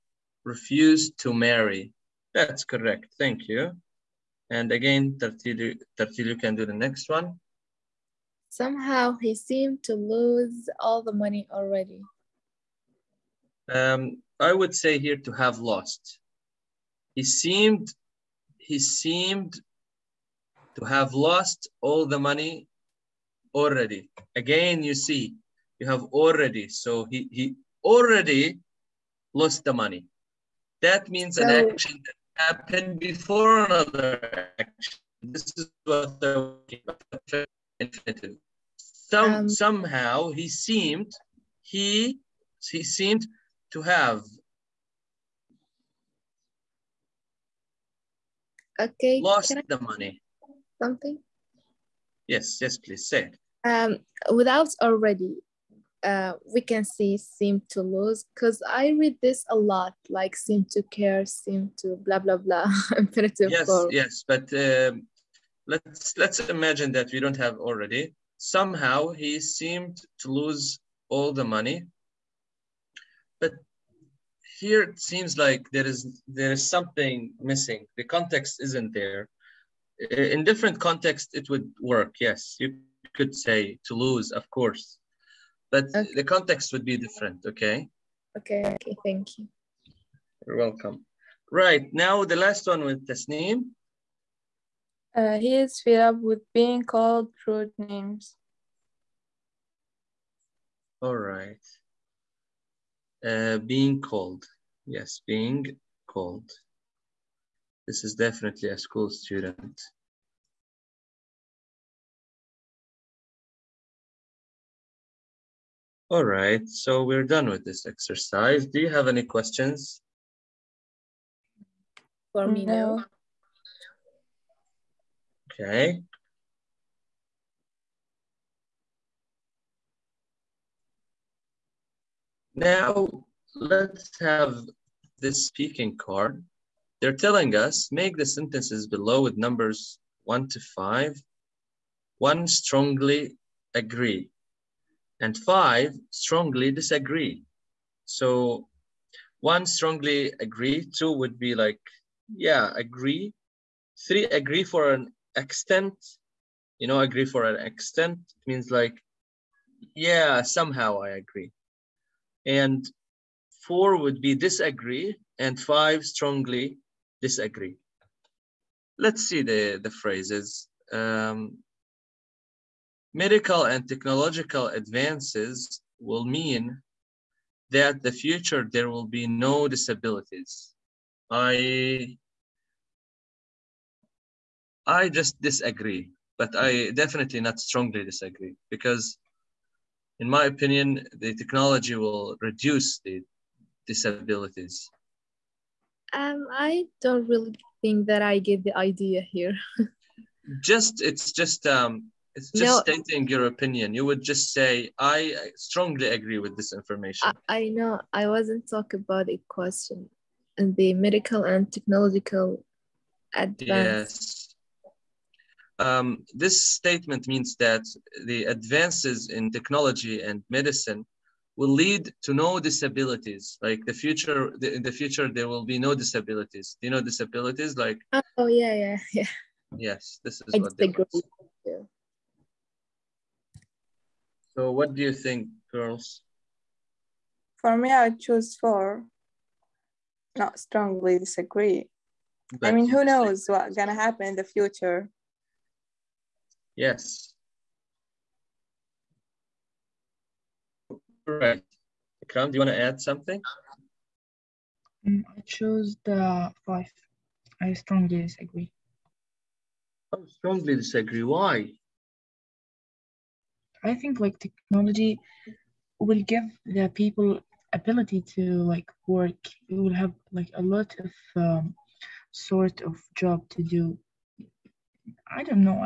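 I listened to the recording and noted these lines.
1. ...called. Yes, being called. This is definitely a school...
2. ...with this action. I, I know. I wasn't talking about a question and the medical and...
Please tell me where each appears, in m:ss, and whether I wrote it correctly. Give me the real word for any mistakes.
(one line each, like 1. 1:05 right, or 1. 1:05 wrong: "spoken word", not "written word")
1. 1:44 right
2. 3:26 wrong: "information", not "action".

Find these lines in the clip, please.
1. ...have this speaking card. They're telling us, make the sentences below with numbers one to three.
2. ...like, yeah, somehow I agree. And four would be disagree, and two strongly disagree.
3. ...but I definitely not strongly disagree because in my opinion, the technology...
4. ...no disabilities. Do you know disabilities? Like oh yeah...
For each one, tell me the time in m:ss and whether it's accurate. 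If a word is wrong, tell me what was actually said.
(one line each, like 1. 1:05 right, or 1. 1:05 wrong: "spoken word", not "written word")
1. 2:14 wrong: "five", not "three"
2. 2:38 wrong: "five", not "two"
3. 3:06 right
4. 3:45 right.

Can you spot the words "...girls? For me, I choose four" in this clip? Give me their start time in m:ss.
3:55.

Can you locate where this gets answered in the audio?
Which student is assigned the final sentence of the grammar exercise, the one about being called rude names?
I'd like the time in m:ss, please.
1:33.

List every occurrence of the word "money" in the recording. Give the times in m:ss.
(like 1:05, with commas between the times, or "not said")
0:11, 0:22, 0:29, 0:49, 1:11.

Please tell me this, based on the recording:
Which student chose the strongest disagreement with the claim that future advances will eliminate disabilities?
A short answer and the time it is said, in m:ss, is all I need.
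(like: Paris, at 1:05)
Ikram, at 4:12.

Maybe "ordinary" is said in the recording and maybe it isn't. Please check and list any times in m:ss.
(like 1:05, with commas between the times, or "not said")
not said.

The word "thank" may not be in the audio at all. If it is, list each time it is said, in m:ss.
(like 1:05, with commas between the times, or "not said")
0:03, 1:29.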